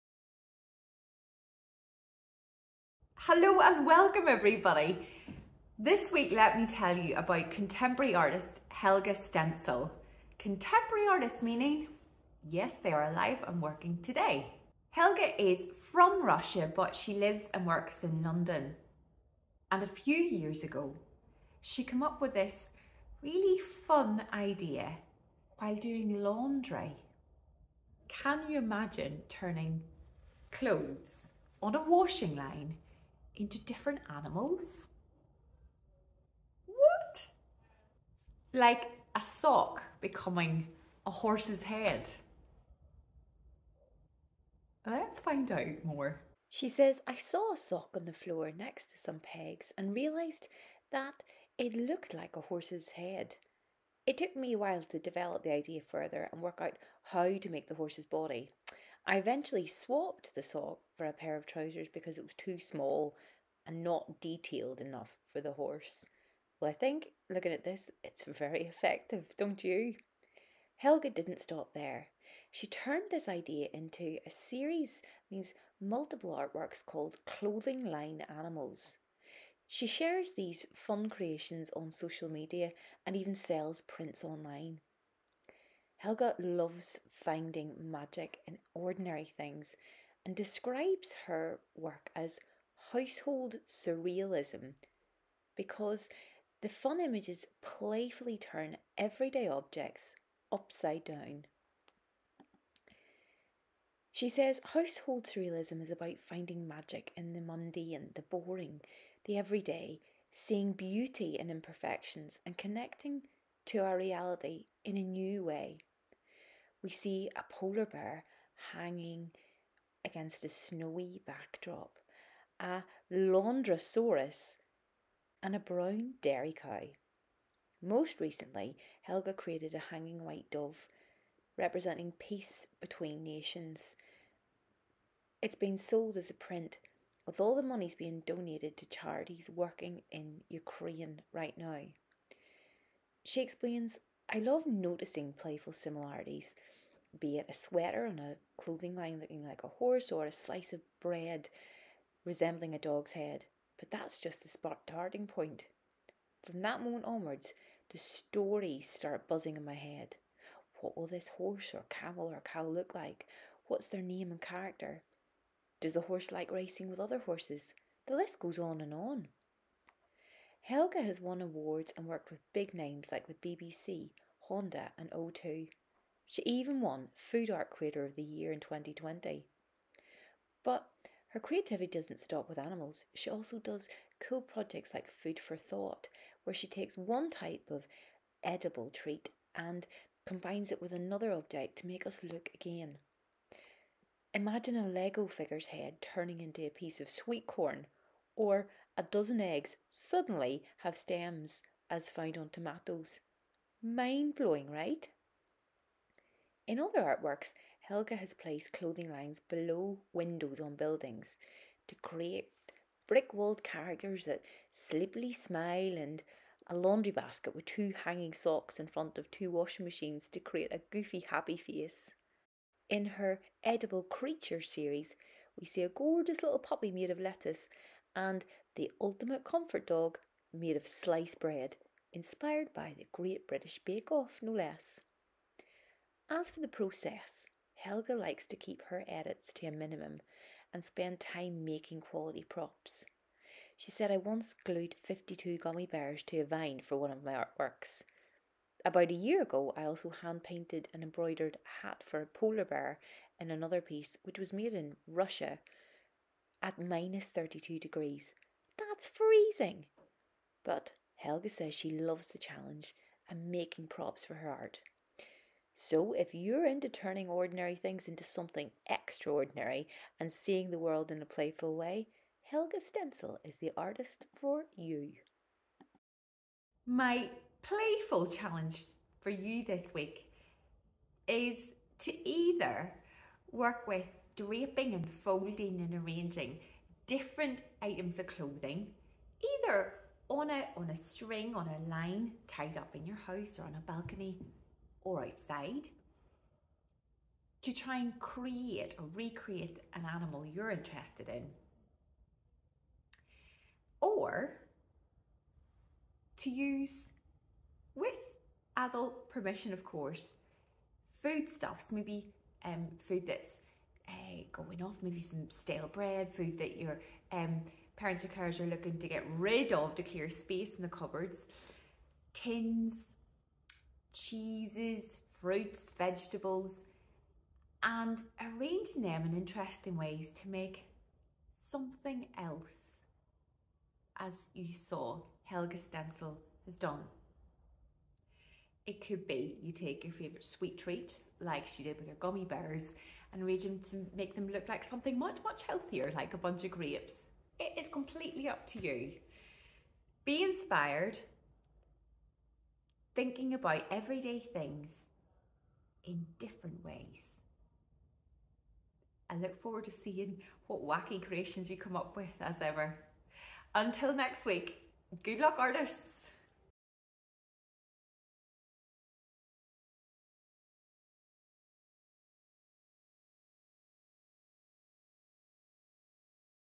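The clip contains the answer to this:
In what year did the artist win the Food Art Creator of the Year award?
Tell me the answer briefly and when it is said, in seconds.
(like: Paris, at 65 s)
2020, at 178 s.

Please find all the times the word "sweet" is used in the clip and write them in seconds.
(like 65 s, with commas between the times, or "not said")
197 s, 340 s.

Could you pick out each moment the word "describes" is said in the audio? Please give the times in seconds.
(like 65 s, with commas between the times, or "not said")
90 s.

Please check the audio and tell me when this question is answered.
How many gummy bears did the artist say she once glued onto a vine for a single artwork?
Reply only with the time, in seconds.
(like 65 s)
245 s.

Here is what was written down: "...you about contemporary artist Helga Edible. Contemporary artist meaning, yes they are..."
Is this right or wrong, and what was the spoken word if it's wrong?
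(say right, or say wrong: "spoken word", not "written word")
wrong: "Stentzel", not "Edible".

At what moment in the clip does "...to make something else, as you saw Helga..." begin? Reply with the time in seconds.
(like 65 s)
330 s.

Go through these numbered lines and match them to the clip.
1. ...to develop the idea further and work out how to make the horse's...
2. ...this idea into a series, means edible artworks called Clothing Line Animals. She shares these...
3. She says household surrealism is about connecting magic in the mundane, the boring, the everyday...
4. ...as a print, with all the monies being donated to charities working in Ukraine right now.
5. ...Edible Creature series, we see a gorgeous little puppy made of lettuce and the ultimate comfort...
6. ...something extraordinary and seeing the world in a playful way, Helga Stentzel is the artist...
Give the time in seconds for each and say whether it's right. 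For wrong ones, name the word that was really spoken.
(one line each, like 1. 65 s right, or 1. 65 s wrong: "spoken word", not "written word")
1. 54 s right
2. 73 s wrong: "multiple", not "edible"
3. 104 s wrong: "finding", not "connecting"
4. 136 s right
5. 223 s right
6. 268 s right.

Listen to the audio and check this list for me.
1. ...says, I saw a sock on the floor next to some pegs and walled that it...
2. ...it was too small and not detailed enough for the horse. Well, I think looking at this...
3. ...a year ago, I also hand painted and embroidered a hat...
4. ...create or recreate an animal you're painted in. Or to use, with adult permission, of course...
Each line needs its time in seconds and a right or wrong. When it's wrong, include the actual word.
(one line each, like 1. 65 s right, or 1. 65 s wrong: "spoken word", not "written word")
1. 46 s wrong: "realised", not "walled"
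2. 62 s right
3. 249 s right
4. 298 s wrong: "interested", not "painted".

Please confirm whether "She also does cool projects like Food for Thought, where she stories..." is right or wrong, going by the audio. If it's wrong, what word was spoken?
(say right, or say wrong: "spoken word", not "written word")
wrong: "takes", not "stories".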